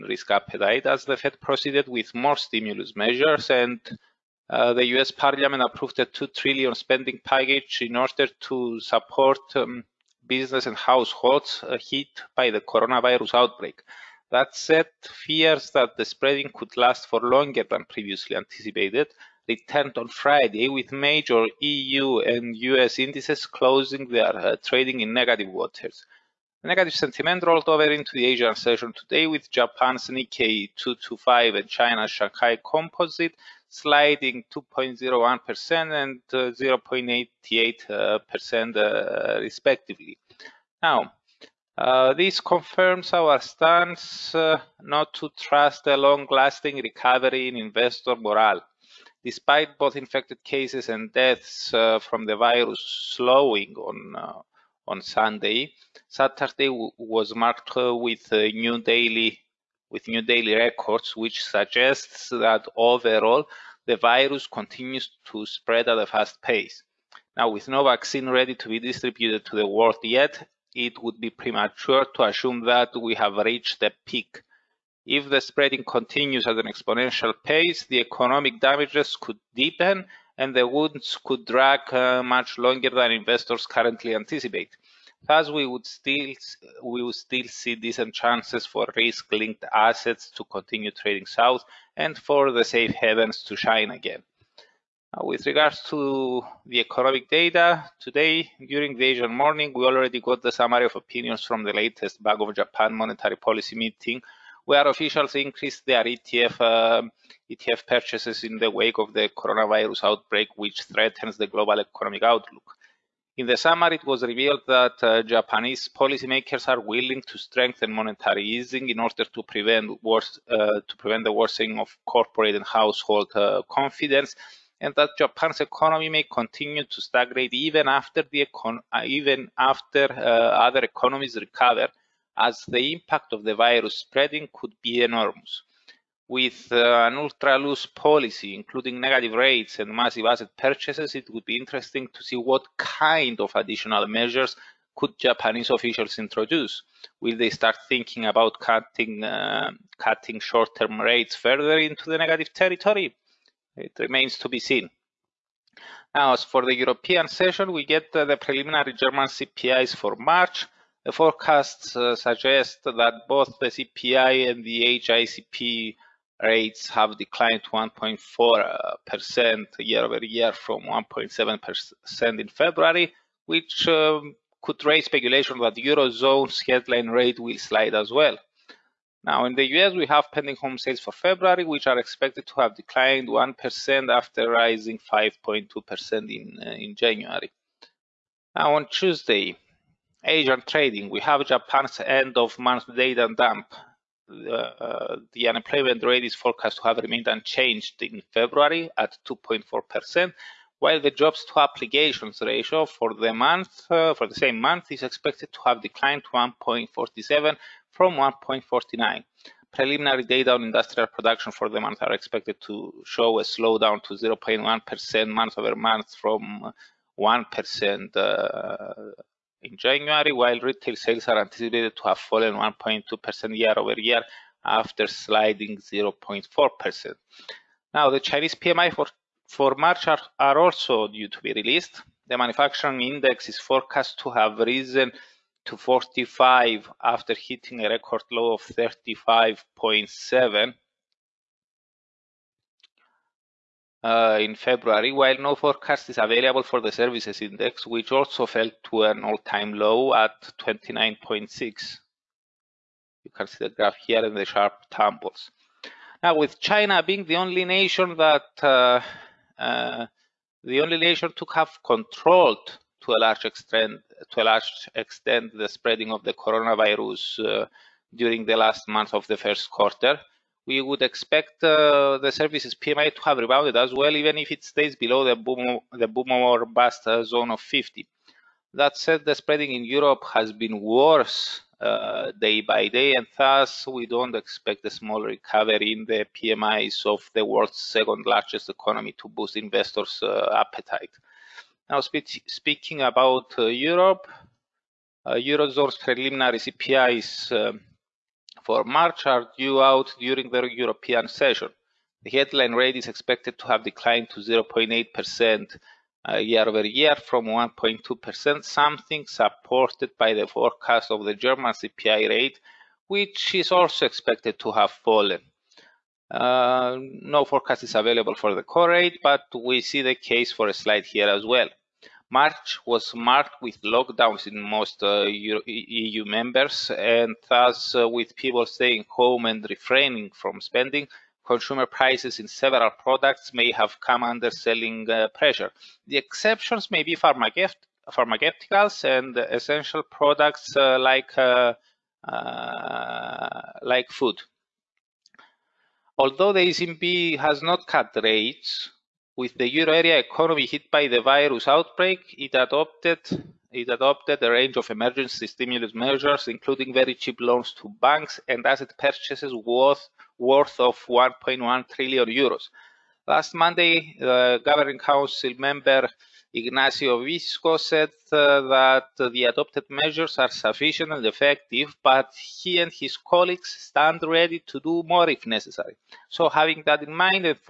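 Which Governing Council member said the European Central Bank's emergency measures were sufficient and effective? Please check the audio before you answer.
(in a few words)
Ignazio Visco.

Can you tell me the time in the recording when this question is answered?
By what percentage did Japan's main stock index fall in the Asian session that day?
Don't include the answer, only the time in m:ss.
0:34.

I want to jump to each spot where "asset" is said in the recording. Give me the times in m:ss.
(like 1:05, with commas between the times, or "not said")
1:29, 2:20, 5:58.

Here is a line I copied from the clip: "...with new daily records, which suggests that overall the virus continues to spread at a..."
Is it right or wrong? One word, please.
right.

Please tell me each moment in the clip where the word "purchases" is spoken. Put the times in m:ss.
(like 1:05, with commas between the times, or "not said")
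1:47, 2:20, 5:58.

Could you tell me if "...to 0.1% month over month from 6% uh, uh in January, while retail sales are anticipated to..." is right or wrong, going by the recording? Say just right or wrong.
wrong.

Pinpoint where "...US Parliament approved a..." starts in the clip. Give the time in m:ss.
0:04.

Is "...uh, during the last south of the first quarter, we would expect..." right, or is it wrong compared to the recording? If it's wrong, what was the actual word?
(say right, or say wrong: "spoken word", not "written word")
wrong: "month", not "south".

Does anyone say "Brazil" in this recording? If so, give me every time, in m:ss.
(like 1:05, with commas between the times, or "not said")
not said.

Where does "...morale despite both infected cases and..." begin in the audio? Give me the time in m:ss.
0:48.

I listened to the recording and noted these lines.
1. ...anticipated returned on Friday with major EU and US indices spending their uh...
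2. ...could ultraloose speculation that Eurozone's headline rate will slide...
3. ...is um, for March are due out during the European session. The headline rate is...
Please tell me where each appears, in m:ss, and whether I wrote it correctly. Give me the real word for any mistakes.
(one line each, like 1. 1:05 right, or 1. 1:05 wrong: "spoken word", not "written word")
1. 0:18 wrong: "closing", not "spending"
2. 2:54 wrong: "raise", not "ultraloose"
3. 4:57 right.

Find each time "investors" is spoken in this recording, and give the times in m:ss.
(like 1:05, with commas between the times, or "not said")
0:47, 1:23, 4:49.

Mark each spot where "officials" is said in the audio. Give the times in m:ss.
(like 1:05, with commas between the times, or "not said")
1:44, 2:25.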